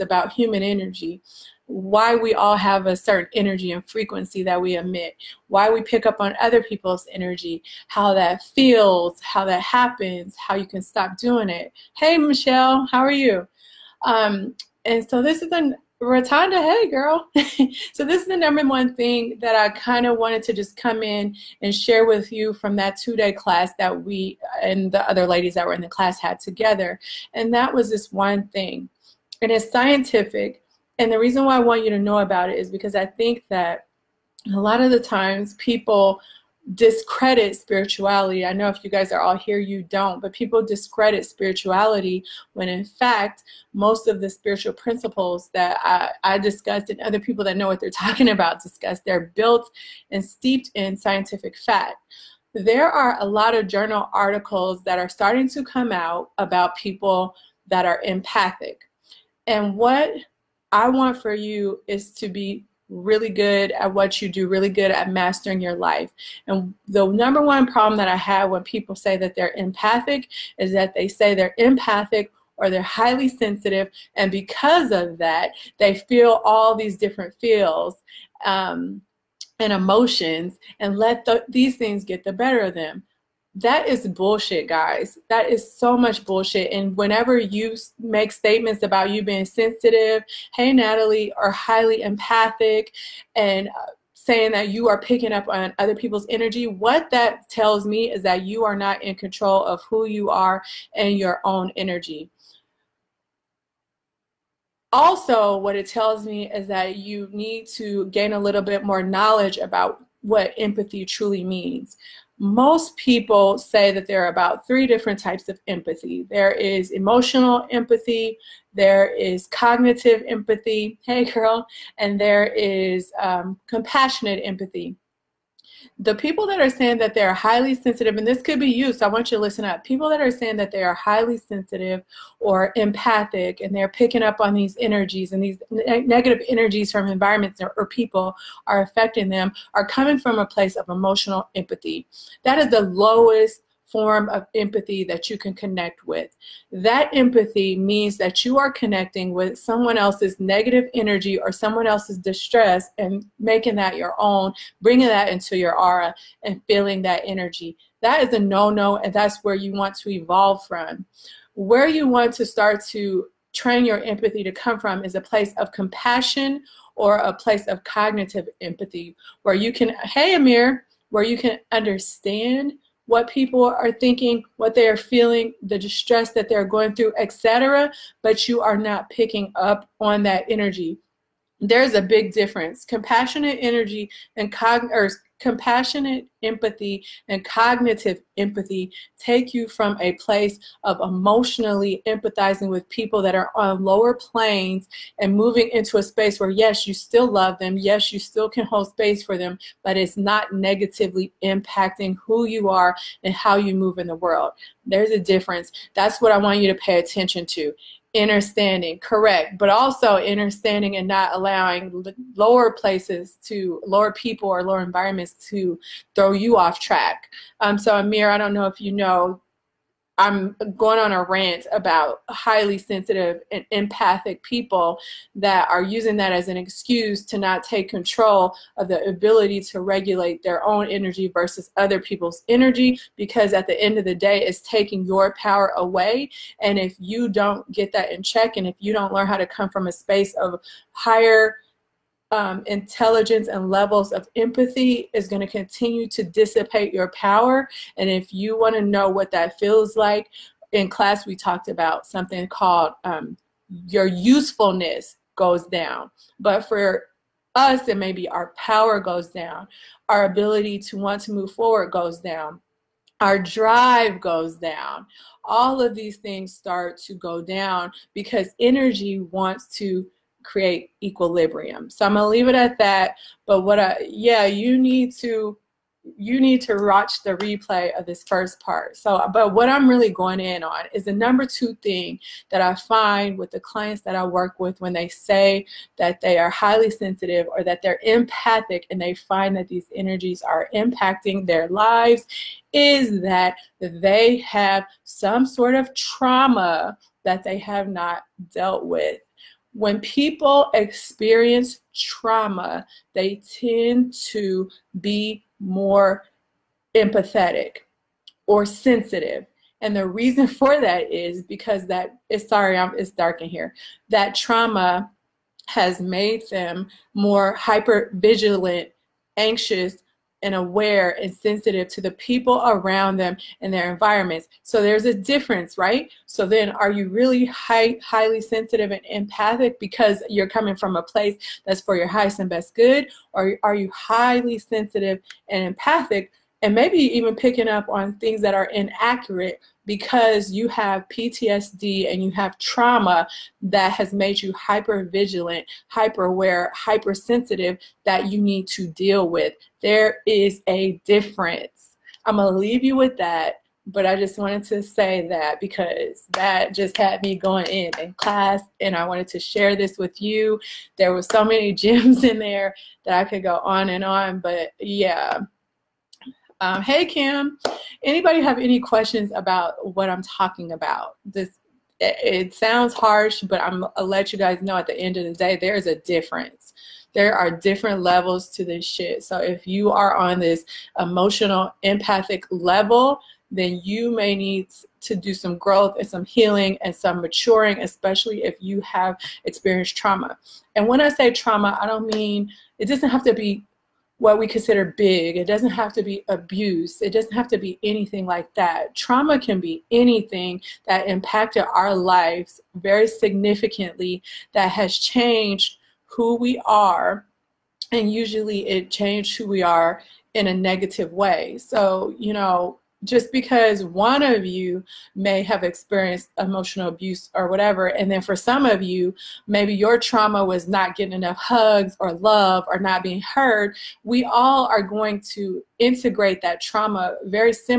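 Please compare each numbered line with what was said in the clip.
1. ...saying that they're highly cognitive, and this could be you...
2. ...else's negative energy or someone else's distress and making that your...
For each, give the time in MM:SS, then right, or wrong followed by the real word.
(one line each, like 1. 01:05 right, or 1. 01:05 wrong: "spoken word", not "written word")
1. 02:06 wrong: "sensitive", not "cognitive"
2. 02:29 right.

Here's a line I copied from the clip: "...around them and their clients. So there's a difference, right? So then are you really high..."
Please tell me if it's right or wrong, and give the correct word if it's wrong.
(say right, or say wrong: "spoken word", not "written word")
wrong: "environments", not "clients".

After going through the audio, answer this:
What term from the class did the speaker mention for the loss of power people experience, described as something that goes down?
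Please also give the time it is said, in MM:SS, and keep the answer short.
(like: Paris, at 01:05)
Usefulness, at 04:13.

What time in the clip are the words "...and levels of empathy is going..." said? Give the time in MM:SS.
04:03.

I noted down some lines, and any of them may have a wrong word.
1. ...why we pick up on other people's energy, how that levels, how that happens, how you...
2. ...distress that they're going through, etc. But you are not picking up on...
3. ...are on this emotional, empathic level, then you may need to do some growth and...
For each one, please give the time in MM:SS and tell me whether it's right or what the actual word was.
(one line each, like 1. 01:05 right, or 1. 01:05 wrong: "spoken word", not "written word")
1. 00:05 wrong: "feels", not "levels"
2. 02:55 right
3. 06:19 right.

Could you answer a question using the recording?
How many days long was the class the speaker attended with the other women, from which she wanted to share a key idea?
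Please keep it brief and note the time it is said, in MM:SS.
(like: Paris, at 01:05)
2, at 00:22.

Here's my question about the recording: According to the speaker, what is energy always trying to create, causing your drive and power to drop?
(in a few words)
Equilibrium.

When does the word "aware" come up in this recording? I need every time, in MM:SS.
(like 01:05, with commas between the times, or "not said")
05:20, 05:46.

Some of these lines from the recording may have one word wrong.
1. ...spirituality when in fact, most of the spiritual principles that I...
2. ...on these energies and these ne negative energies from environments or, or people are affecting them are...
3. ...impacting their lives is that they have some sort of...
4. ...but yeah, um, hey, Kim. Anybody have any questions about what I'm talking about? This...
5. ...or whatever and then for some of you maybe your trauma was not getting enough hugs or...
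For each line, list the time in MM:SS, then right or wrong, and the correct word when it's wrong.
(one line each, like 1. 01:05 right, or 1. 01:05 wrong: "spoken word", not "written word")
1. 00:41 right
2. 02:14 right
3. 04:50 right
4. 06:04 right
5. 06:57 right.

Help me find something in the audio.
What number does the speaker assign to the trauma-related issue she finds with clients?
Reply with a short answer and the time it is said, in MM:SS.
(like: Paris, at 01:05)
2, at 04:41.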